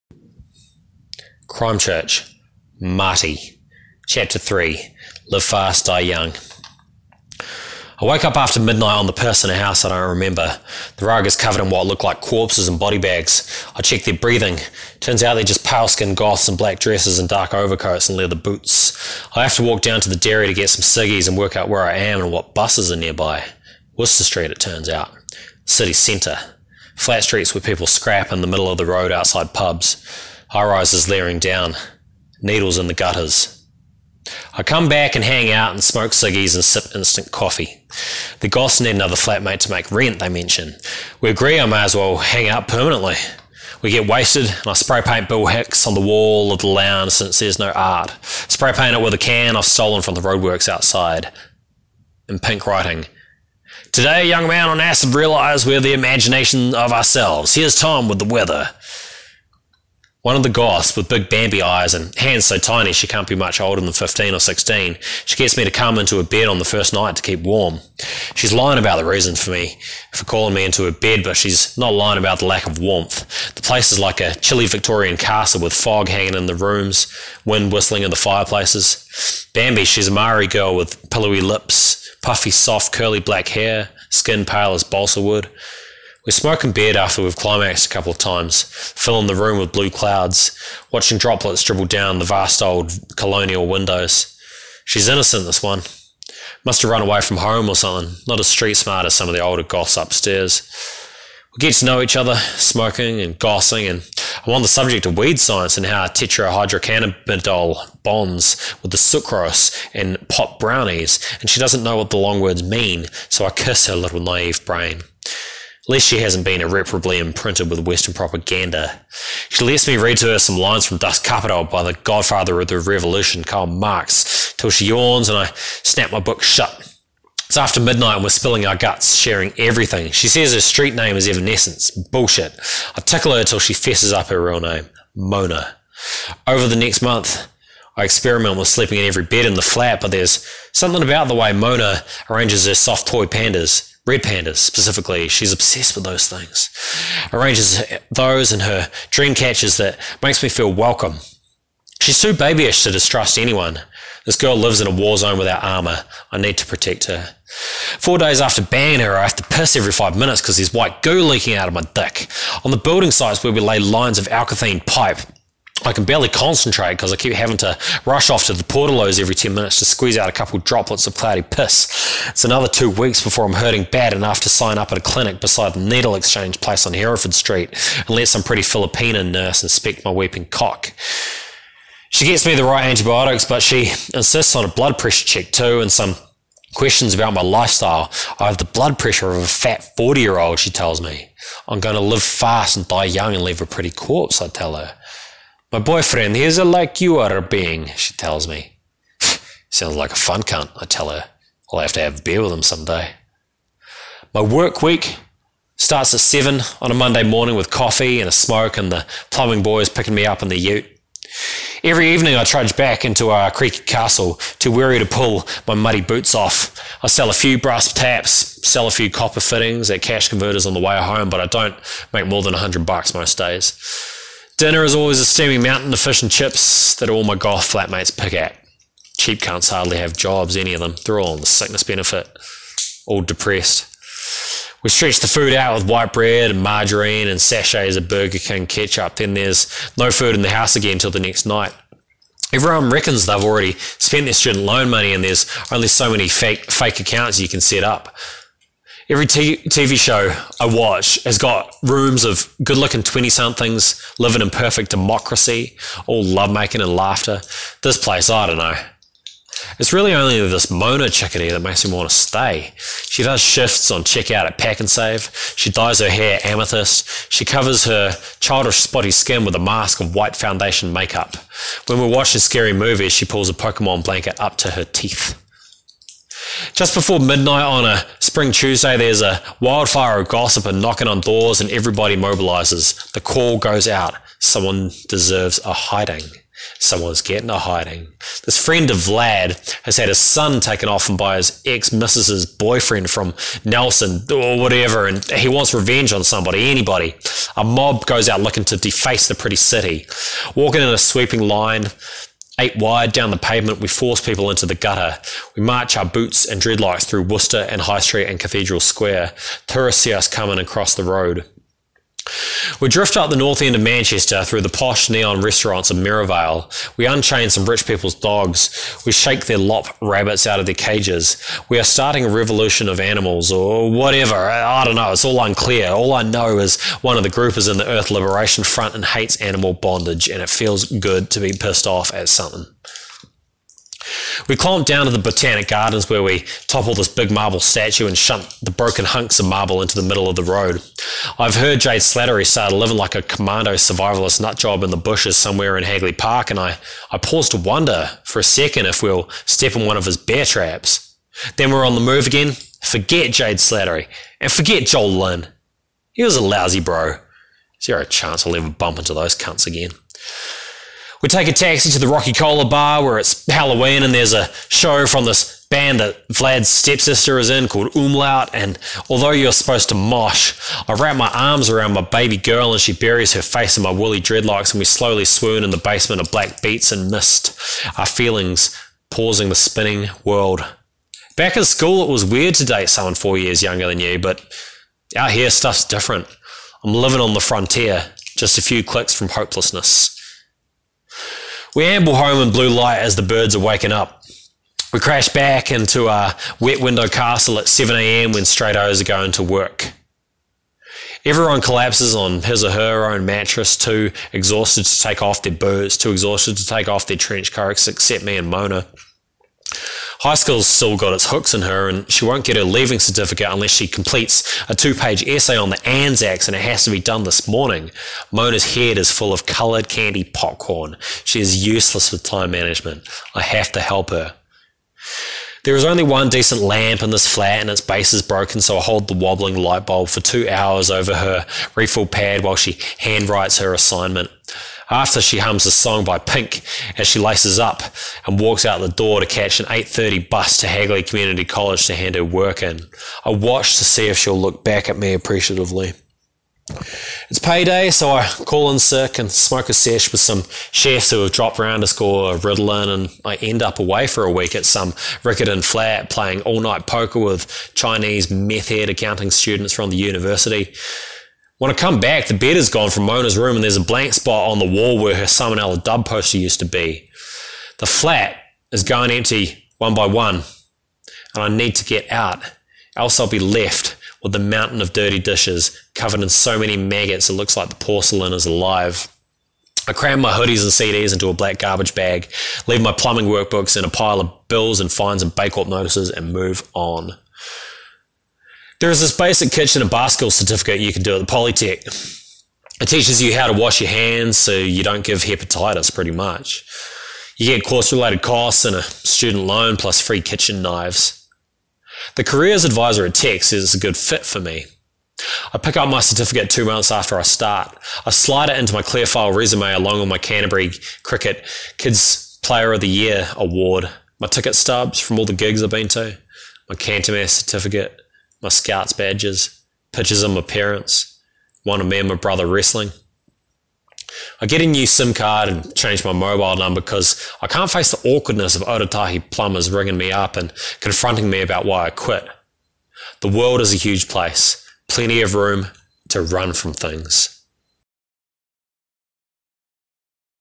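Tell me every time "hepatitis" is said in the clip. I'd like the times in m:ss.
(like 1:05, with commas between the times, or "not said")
8:15.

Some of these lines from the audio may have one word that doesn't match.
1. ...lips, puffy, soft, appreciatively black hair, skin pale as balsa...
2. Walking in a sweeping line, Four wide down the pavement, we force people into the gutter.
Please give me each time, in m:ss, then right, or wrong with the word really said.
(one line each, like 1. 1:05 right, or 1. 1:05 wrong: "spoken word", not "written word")
1. 1:21 wrong: "curly", not "appreciatively"
2. 5:00 wrong: "Eight", not "Four".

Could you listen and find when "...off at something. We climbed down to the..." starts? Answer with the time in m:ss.
5:31.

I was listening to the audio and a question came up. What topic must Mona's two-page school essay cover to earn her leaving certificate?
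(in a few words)
the Anzacs.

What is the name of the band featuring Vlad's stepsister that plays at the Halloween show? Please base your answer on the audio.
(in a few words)
Umlaut.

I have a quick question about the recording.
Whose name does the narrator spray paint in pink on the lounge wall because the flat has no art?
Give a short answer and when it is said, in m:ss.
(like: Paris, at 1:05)
Bill Hicks, at 0:45.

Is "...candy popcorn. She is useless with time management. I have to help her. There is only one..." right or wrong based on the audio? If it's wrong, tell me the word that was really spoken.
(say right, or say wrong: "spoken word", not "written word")
right.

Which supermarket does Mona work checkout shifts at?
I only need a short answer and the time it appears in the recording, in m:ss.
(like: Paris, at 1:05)
Pak'nSave, at 4:24.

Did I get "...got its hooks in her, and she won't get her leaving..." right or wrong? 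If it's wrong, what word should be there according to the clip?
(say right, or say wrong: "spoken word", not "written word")
right.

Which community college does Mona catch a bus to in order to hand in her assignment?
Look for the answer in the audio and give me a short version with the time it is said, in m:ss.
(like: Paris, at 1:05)
Hagley Community College, at 7:20.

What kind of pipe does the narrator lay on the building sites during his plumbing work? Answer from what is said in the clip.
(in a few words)
alkathene.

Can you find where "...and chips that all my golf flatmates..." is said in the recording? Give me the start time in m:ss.
3:46.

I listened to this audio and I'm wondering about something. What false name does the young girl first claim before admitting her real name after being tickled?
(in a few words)
Evanescence.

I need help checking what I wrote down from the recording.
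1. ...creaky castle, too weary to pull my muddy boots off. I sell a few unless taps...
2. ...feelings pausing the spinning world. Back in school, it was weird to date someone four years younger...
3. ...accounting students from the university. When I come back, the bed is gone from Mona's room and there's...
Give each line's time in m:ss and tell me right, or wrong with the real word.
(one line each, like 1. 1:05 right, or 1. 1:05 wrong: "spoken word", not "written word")
1. 3:33 wrong: "brass", not "unless"
2. 6:18 right
3. 7:38 right.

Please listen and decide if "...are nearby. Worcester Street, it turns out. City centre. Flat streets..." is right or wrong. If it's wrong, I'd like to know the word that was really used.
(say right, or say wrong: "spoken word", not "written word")
right.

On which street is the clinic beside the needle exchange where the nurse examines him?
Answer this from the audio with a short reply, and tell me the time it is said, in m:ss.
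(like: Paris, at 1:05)
Hereford Street, at 2:56.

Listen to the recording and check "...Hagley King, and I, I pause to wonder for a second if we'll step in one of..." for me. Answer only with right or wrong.
wrong.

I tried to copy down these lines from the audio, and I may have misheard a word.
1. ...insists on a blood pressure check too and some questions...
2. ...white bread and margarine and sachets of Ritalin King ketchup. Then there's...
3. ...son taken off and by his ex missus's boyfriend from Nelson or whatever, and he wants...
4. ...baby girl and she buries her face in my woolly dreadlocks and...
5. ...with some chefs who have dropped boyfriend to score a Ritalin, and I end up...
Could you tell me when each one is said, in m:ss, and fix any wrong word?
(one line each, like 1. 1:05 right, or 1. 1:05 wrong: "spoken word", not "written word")
1. 3:04 right
2. 3:55 wrong: "Burger", not "Ritalin"
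3. 4:50 right
4. 6:12 right
5. 7:30 wrong: "round", not "boyfriend".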